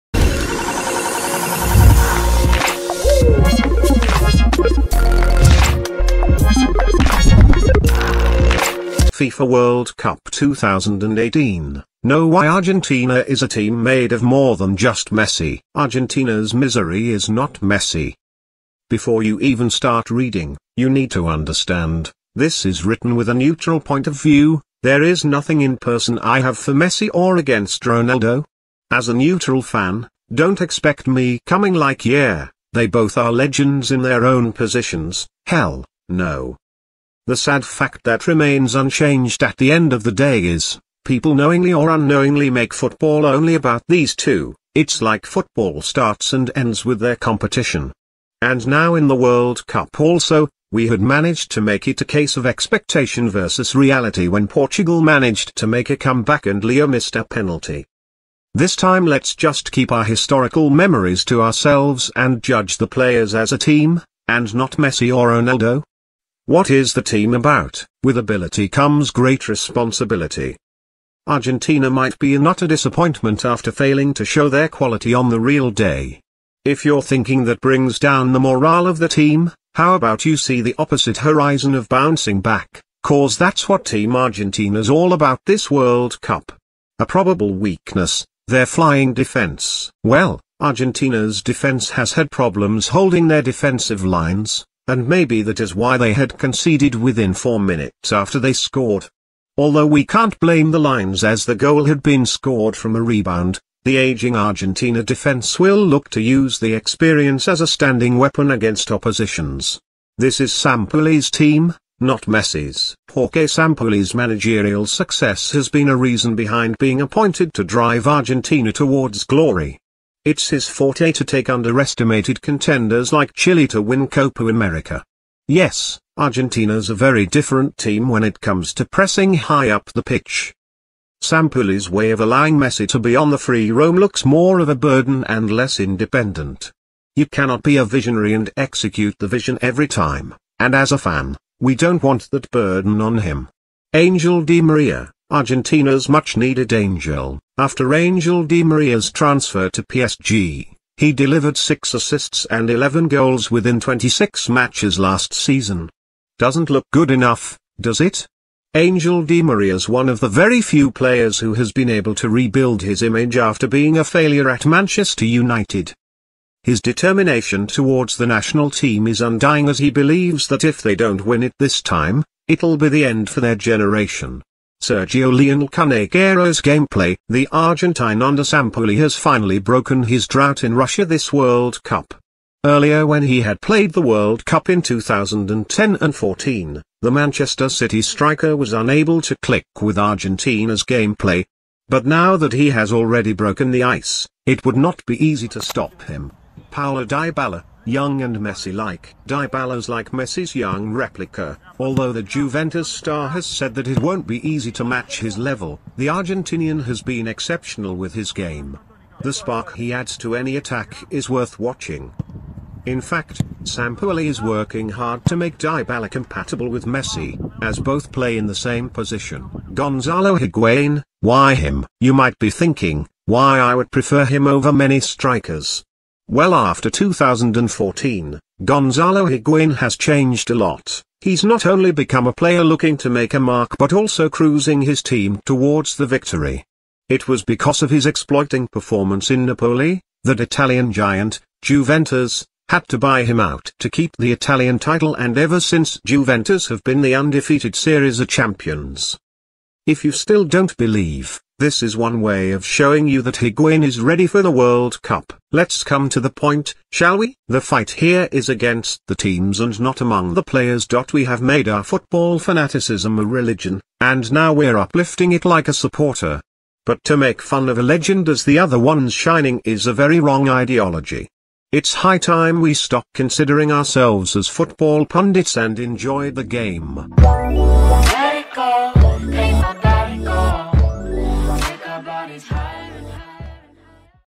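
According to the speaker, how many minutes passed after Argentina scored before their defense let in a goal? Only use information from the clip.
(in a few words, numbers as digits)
4.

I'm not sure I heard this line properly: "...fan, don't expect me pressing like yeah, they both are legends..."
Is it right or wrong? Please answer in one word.
wrong.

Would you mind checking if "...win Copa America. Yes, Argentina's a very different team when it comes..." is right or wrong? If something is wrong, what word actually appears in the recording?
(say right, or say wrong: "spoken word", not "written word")
right.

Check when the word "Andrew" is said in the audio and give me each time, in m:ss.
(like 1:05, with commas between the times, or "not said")
not said.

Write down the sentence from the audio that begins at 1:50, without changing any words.
This is Sampaoli's team, not Messi's.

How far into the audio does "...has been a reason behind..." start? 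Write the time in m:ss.
1:55.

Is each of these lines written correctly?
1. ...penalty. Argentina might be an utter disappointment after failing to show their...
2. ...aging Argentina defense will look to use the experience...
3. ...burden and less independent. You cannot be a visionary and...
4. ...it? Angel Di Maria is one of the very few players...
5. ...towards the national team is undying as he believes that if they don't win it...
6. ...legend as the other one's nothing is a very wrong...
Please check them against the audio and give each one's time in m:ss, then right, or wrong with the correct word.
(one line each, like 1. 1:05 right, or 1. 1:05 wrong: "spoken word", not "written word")
1. 1:09 wrong: "responsibility", not "penalty"
2. 1:43 right
3. 2:14 right
4. 2:38 right
5. 2:47 right
6. 4:27 wrong: "shining", not "nothing".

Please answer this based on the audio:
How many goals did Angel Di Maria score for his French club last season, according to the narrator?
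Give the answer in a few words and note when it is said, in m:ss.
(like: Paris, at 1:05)
11, at 2:32.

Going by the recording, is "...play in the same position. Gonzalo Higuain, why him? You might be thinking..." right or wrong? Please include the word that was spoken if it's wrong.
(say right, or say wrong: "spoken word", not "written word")
right.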